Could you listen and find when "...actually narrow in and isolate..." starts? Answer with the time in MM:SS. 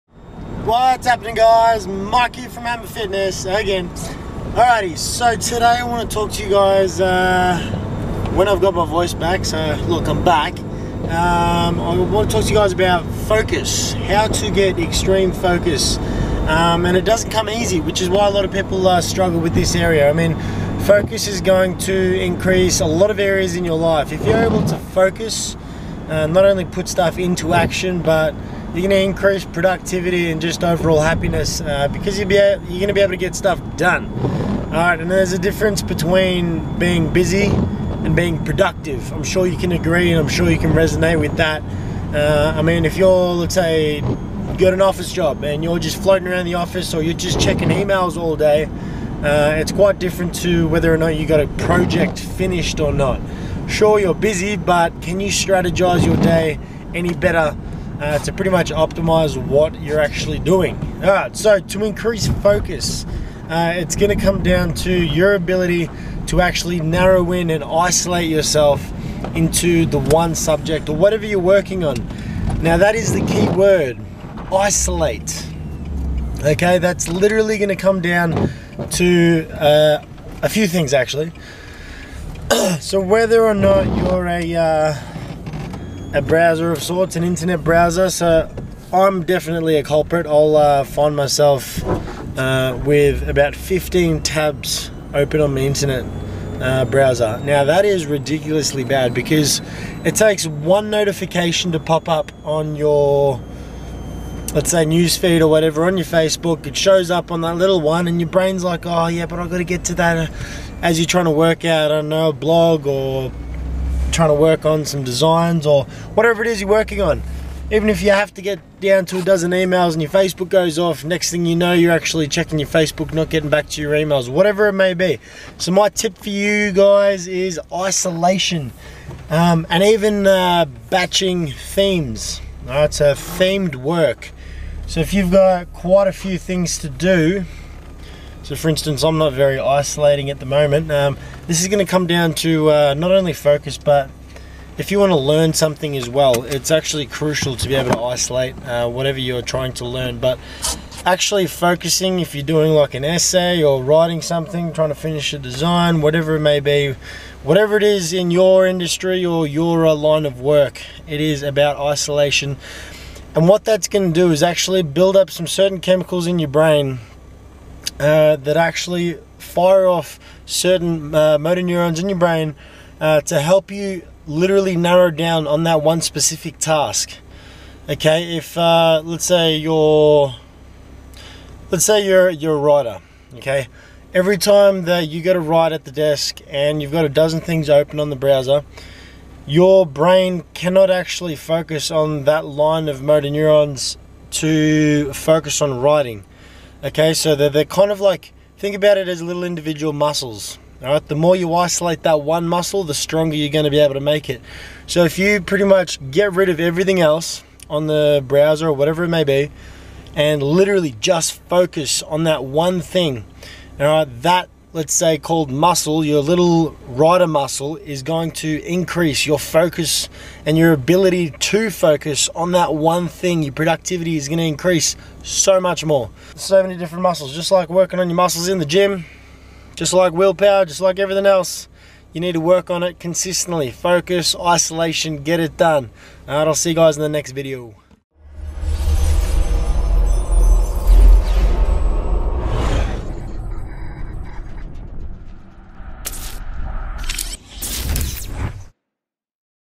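01:06.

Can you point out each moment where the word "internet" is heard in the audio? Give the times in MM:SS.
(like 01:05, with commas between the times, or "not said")
01:27, 01:35.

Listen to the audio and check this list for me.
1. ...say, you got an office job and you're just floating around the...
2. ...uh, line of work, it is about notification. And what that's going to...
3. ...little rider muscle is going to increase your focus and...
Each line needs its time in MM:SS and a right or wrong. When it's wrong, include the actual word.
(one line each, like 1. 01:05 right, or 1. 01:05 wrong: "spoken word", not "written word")
1. 00:43 right
2. 02:39 wrong: "isolation", not "notification"
3. 03:36 right.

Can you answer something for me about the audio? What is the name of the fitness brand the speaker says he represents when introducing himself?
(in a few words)
Hammrr Fitness.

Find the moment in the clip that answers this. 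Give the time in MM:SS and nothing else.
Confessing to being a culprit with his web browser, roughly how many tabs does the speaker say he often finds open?
01:33.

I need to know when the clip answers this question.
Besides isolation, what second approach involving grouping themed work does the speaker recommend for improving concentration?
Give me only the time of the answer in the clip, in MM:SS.
02:10.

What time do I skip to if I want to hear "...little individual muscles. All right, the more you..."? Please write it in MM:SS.
03:19.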